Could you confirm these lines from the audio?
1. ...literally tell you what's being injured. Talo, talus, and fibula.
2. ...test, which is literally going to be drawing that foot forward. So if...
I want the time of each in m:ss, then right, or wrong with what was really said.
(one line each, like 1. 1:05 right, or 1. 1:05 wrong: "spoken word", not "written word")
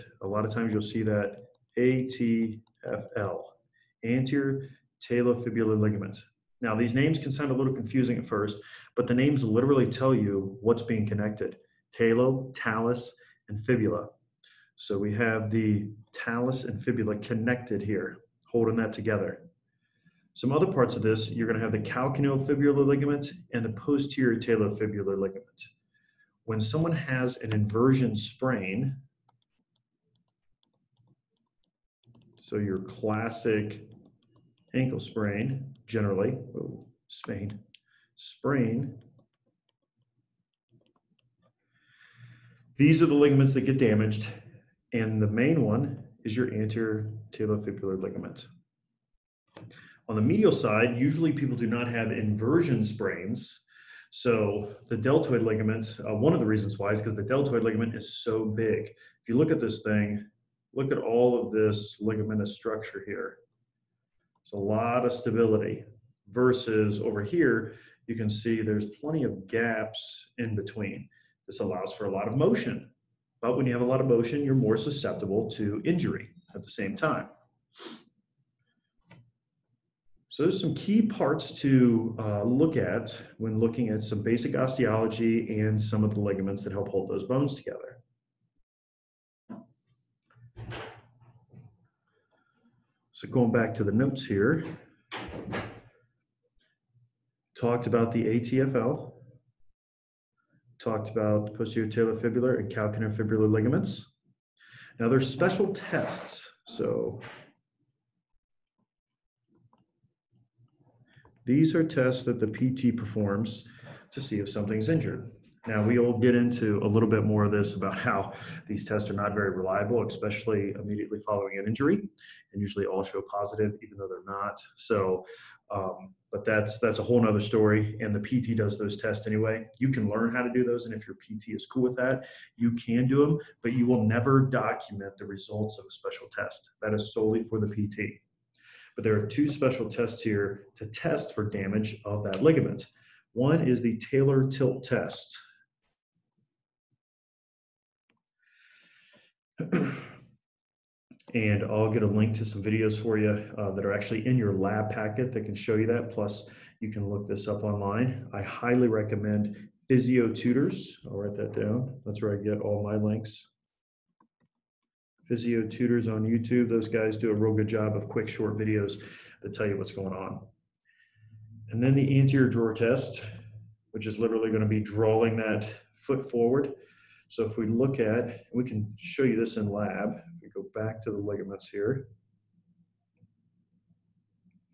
1. 0:09 wrong: "connected", not "injured"
2. 2:52 right.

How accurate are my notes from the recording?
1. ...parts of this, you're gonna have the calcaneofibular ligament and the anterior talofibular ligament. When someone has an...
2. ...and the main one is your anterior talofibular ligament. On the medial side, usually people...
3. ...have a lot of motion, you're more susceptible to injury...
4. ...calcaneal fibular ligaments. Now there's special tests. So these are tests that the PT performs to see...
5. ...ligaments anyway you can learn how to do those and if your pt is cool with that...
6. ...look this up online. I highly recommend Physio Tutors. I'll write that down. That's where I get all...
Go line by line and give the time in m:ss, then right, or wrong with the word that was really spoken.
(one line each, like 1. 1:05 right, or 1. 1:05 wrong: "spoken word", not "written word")
1. 0:20 wrong: "posterior", not "anterior"
2. 0:44 right
3. 1:13 right
4. 1:42 right
5. 2:09 wrong: "tests", not "ligaments"
6. 2:37 right.